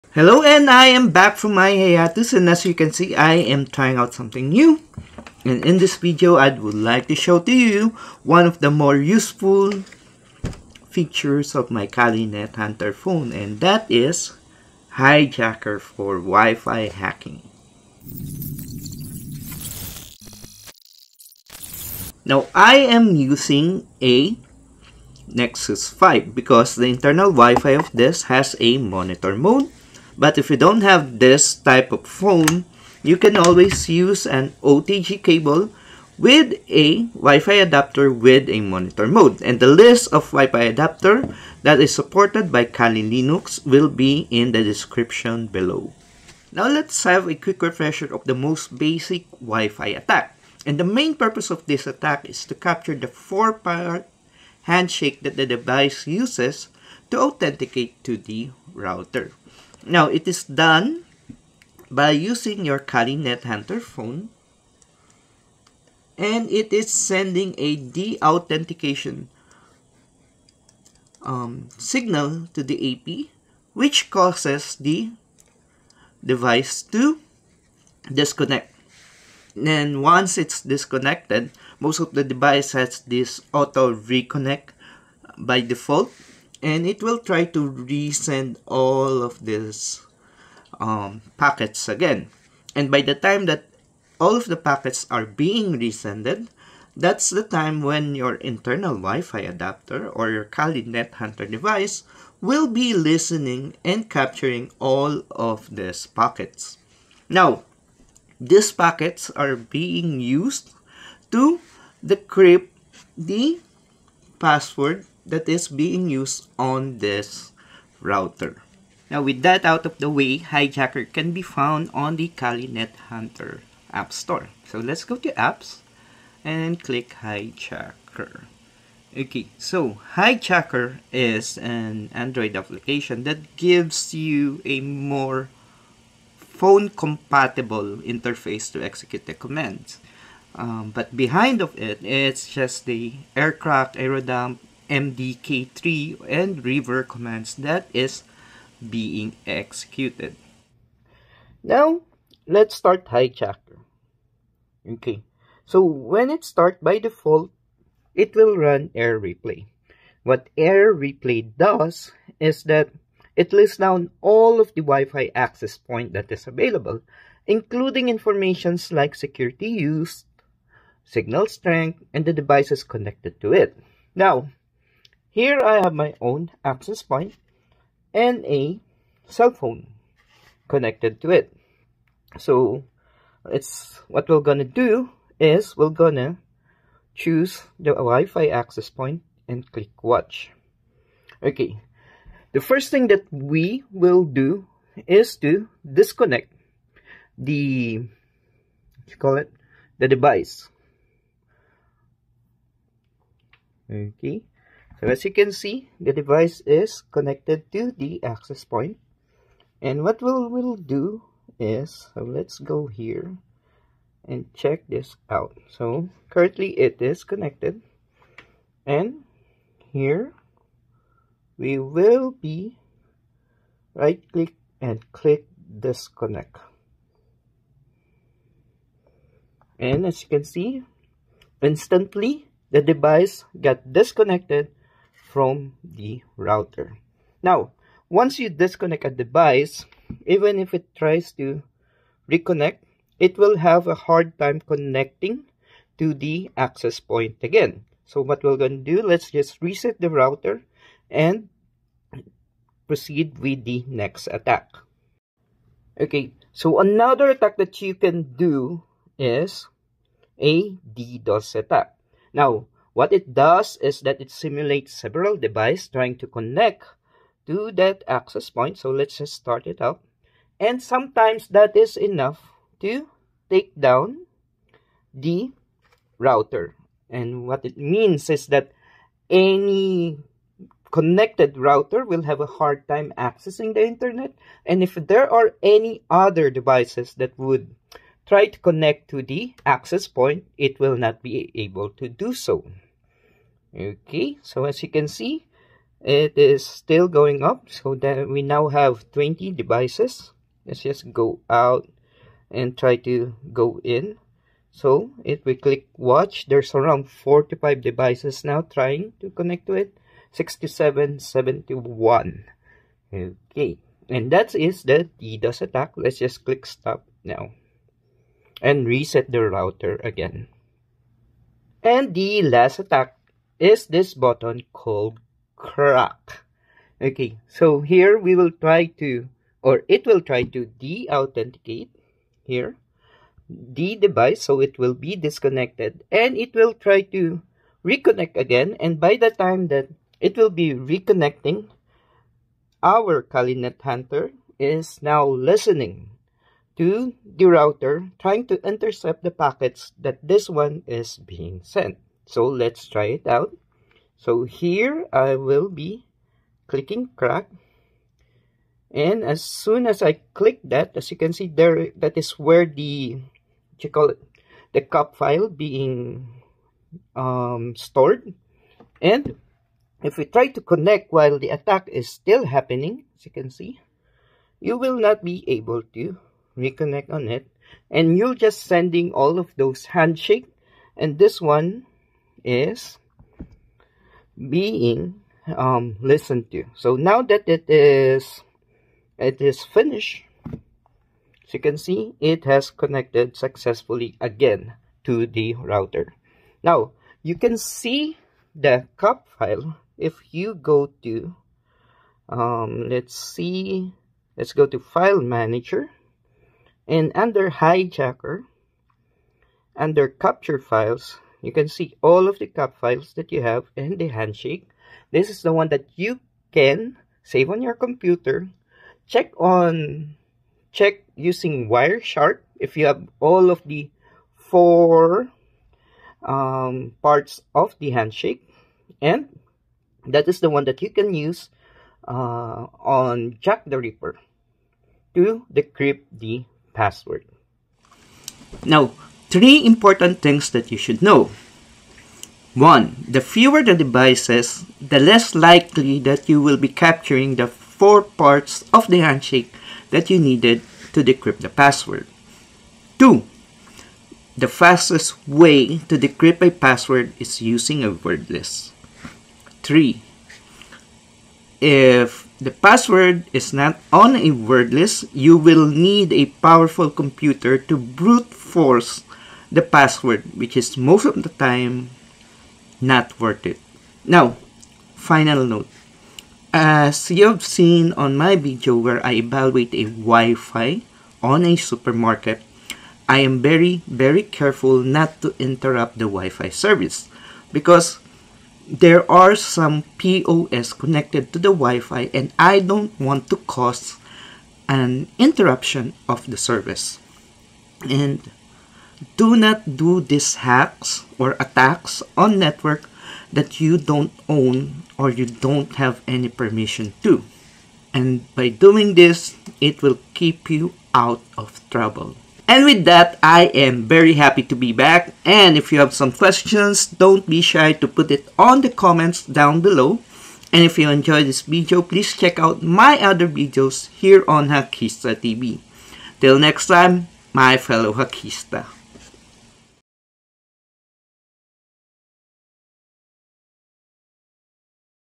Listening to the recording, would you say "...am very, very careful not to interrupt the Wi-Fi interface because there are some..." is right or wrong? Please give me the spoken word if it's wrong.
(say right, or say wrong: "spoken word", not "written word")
wrong: "service", not "interface".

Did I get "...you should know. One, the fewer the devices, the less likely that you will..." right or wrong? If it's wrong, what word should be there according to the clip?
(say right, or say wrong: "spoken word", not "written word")
right.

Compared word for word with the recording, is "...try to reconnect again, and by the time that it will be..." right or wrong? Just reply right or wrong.
right.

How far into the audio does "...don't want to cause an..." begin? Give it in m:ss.
8:12.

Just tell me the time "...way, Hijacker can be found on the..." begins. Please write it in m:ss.
2:00.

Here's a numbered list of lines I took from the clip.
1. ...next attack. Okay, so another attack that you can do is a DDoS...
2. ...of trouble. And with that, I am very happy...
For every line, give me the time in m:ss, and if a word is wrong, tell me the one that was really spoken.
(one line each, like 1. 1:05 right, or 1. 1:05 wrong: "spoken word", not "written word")
1. 4:13 right
2. 8:31 right.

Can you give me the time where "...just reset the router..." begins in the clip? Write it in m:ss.
4:09.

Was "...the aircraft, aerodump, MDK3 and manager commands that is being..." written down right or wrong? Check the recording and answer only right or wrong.
wrong.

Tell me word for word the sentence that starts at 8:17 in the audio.
And do not do these hacks or attacks on network that you don't own or you don't have any permission to.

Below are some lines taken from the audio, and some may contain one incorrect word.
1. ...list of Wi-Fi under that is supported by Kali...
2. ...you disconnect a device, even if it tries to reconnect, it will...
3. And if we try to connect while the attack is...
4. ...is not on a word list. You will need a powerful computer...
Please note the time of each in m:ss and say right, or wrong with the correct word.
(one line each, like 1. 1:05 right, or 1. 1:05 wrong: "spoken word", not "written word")
1. 0:39 wrong: "adapter", not "under"
2. 3:58 right
3. 6:08 right
4. 7:43 right.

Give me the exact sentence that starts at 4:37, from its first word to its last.
And what it means is that any connected router will have a hard time accessing the internet.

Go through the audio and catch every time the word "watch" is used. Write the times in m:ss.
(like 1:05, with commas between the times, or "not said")
3:10, 5:05.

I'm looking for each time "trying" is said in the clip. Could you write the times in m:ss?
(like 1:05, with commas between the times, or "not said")
0:03, 4:25, 5:08, 5:48.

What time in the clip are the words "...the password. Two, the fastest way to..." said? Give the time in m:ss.
7:31.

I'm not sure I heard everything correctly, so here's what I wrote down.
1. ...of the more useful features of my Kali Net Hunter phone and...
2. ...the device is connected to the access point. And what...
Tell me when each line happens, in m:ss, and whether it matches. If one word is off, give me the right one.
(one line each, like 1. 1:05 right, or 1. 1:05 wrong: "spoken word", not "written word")
1. 0:08 right
2. 3:25 right.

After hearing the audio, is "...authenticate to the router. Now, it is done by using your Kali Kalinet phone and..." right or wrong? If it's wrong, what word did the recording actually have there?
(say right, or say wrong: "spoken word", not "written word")
wrong: "Hunter", not "Kalinet".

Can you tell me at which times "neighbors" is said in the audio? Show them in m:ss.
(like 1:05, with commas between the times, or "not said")
not said.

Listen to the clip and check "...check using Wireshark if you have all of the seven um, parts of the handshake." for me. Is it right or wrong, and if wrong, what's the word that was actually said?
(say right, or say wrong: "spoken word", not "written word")
wrong: "four", not "seven".